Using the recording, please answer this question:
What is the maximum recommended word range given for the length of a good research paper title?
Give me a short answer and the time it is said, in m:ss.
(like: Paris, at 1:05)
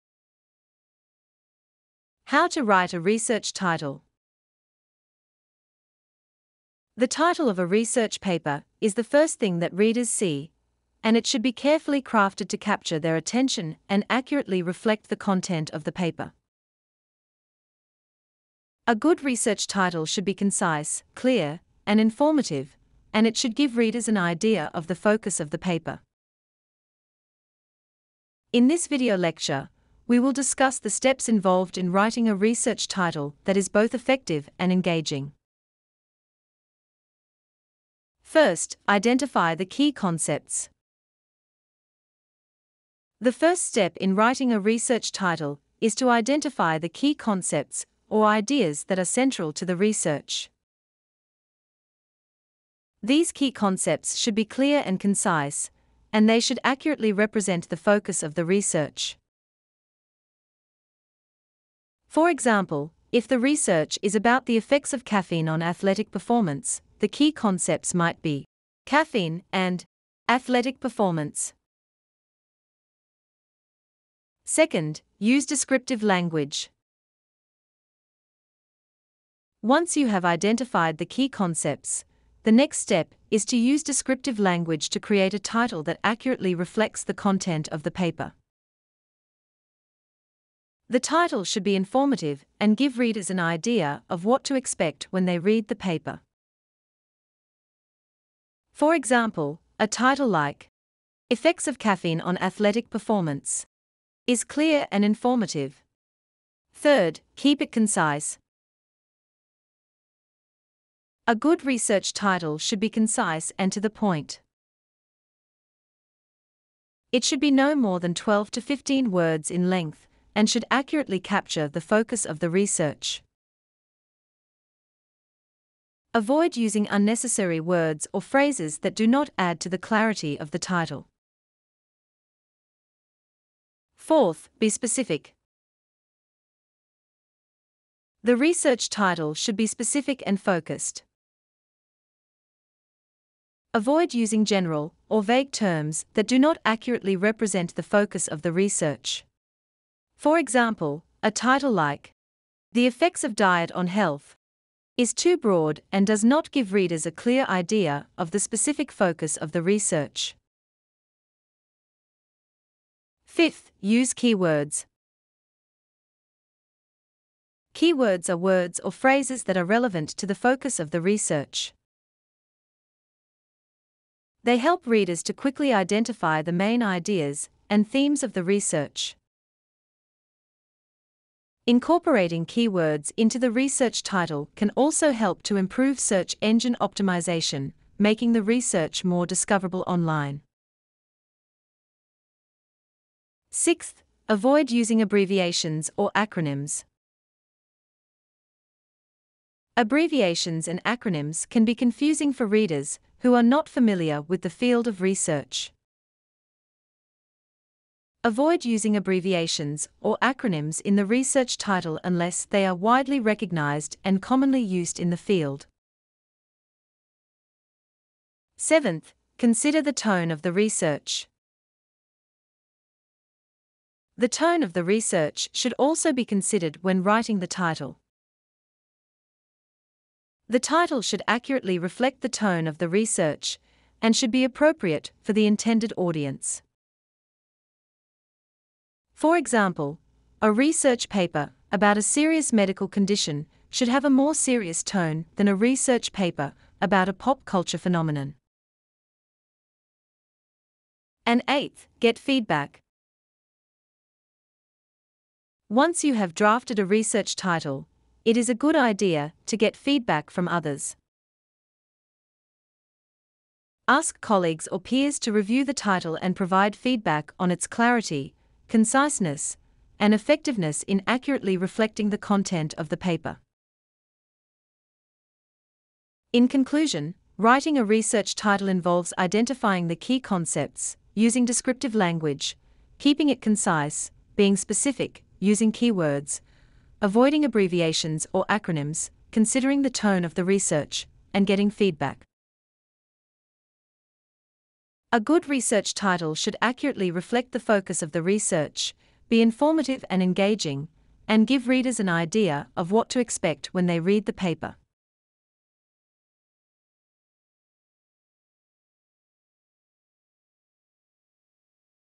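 12 to 15 words, at 1:58.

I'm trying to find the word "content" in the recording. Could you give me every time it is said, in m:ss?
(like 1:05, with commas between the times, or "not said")
0:15, 1:27, 4:32.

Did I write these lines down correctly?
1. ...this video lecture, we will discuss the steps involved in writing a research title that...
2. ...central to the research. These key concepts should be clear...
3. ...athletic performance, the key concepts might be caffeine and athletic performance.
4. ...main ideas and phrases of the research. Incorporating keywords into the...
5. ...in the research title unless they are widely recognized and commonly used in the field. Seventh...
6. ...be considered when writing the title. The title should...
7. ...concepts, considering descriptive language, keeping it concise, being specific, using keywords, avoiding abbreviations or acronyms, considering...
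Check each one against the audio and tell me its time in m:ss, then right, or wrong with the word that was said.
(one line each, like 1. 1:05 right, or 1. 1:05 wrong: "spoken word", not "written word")
1. 0:28 right
2. 0:49 right
3. 1:05 right
4. 2:56 wrong: "themes", not "phrases"
5. 3:30 right
6. 3:46 right
7. 4:40 wrong: "using", not "considering".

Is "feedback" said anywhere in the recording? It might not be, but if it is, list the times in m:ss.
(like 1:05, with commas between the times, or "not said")
4:12, 4:19, 4:26, 4:51.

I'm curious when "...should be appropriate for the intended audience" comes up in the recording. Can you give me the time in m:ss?
3:54.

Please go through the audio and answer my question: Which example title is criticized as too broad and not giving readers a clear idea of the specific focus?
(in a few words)
The Effects of Diet on Health.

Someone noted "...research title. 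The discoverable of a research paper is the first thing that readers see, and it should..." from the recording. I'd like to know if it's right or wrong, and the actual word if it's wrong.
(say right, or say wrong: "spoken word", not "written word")
wrong: "title", not "discoverable".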